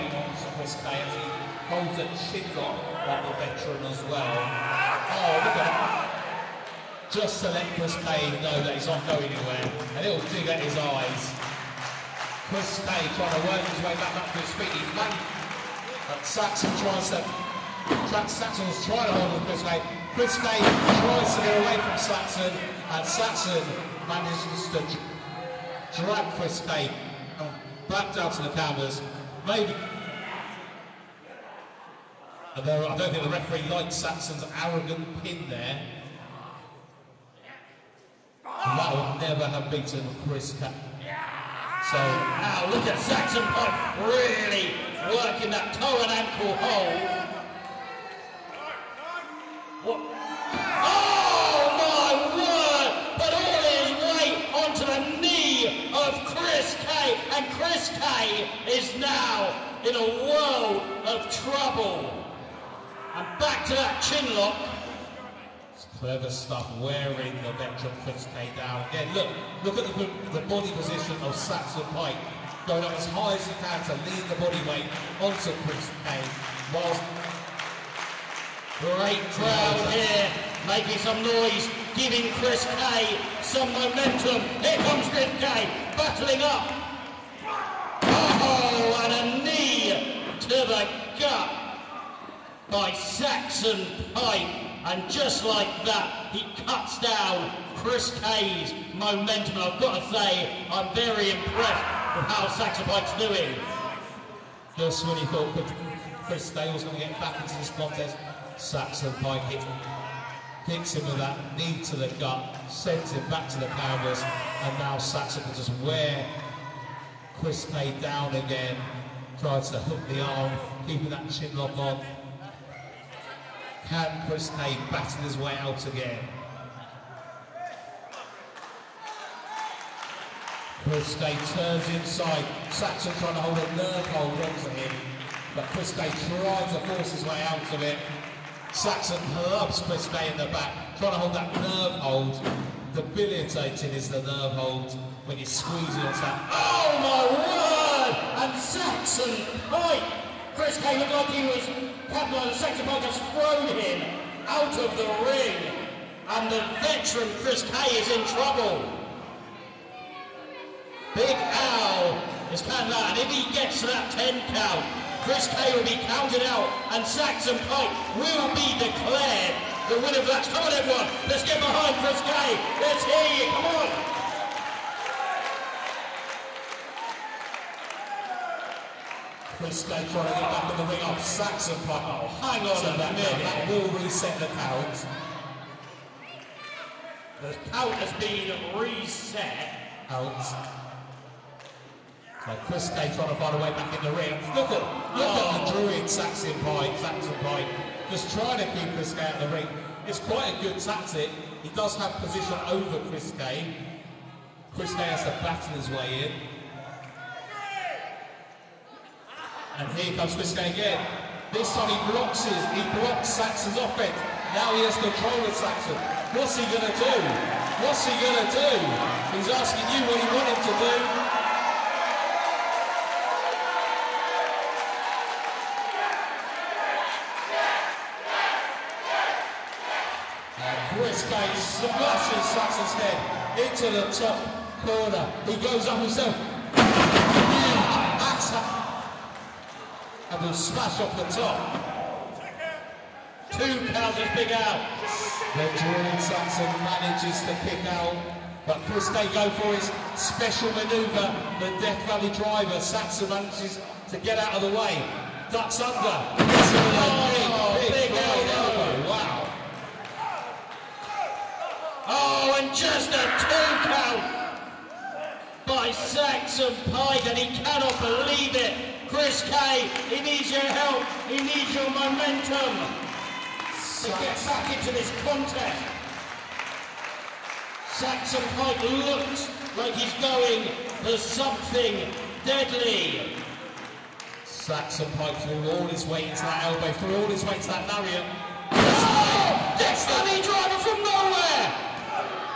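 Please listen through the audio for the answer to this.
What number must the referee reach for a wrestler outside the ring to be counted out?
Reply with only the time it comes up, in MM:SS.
02:44.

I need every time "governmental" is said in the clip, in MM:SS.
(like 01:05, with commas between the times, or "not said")
not said.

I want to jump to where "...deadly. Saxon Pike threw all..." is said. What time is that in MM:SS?
04:42.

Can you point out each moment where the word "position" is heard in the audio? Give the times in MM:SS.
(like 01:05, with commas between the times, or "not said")
01:10, 03:22.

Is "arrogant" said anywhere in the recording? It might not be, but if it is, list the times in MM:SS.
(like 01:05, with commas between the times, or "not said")
00:34.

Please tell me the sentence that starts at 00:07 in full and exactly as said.
Just to let Chris Kane know that he's not going anywhere.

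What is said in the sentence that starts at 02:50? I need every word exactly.
Come on, everyone, let's get behind Kris Kay.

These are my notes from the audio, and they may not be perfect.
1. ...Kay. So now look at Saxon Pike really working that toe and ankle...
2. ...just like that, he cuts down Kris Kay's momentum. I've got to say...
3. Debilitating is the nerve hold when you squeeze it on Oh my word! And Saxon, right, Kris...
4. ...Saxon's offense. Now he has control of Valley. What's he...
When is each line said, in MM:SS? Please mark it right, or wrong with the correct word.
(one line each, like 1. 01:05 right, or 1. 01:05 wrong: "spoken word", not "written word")
1. 00:40 right
2. 01:35 right
3. 02:22 right
4. 03:33 wrong: "Saxon", not "Valley".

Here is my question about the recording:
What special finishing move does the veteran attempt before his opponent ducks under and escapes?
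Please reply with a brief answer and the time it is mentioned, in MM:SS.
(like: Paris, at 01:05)
Death Valley driver, at 04:11.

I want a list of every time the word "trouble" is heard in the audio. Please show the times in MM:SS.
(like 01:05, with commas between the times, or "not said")
01:01, 02:38.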